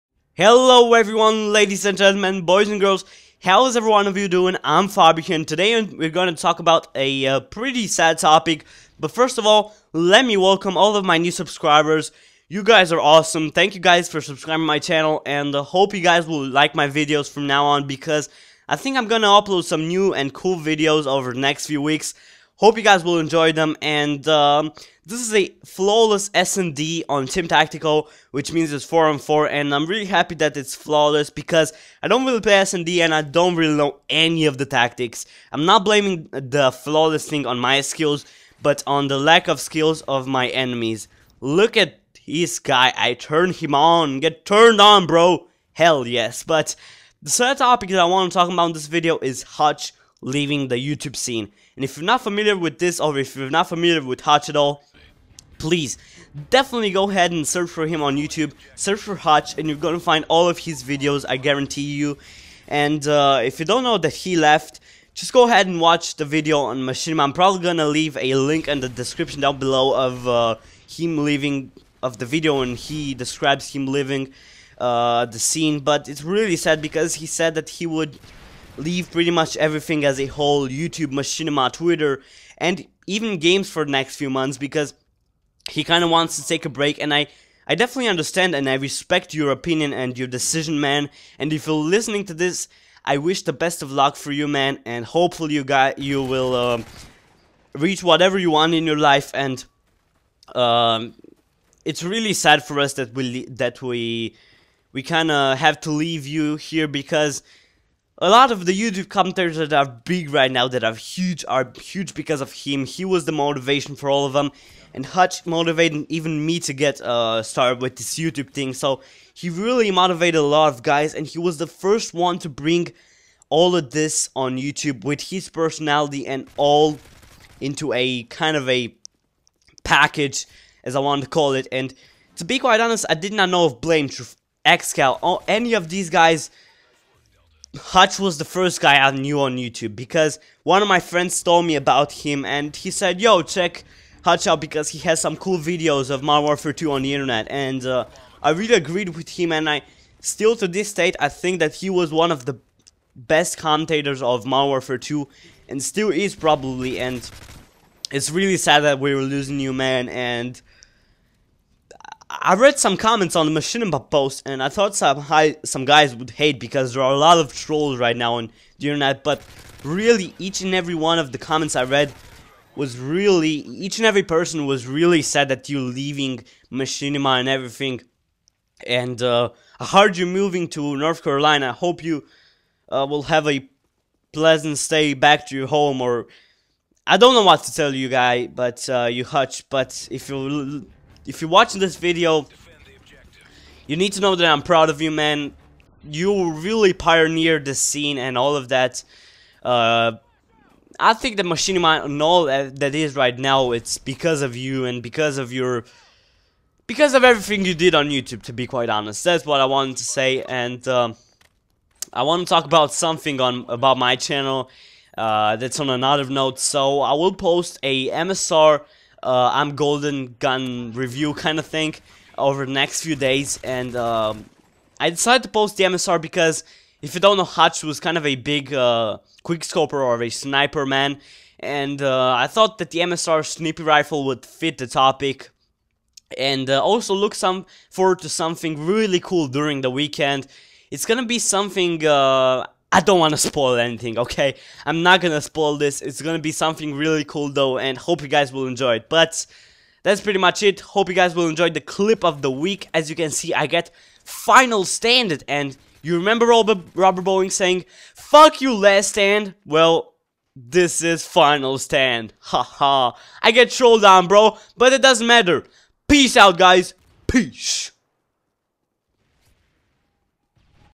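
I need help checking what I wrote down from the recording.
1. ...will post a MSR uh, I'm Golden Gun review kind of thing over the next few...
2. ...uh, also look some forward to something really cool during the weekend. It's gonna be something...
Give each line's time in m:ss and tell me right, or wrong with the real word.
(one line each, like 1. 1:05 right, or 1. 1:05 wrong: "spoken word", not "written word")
1. 3:37 right
2. 3:56 right.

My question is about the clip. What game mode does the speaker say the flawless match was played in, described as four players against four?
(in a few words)
Team Tactical.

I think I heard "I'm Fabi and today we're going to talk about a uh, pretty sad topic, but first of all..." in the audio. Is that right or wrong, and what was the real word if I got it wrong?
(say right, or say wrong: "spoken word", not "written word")
right.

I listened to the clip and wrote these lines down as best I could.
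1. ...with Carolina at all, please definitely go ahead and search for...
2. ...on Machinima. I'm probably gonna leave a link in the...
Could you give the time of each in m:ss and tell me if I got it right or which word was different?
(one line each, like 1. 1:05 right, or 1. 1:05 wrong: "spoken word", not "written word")
1. 0:54 wrong: "Hutch", not "Carolina"
2. 1:06 right.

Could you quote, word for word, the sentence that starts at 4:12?
As you can see, I get final stand And You remember Robert, Robert Bowling saying, Fuck you, last stand?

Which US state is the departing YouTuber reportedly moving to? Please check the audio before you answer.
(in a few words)
North Carolina.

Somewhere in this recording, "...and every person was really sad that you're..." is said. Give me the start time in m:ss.
2:53.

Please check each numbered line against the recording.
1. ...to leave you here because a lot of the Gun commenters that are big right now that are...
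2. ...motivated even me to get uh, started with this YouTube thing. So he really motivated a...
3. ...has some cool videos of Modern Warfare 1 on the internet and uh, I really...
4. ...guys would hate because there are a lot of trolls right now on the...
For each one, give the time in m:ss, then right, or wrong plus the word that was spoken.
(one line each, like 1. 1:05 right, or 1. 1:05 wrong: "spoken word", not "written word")
1. 1:45 wrong: "YouTube", not "Gun"
2. 1:55 right
3. 2:24 wrong: "2", not "1"
4. 2:45 right.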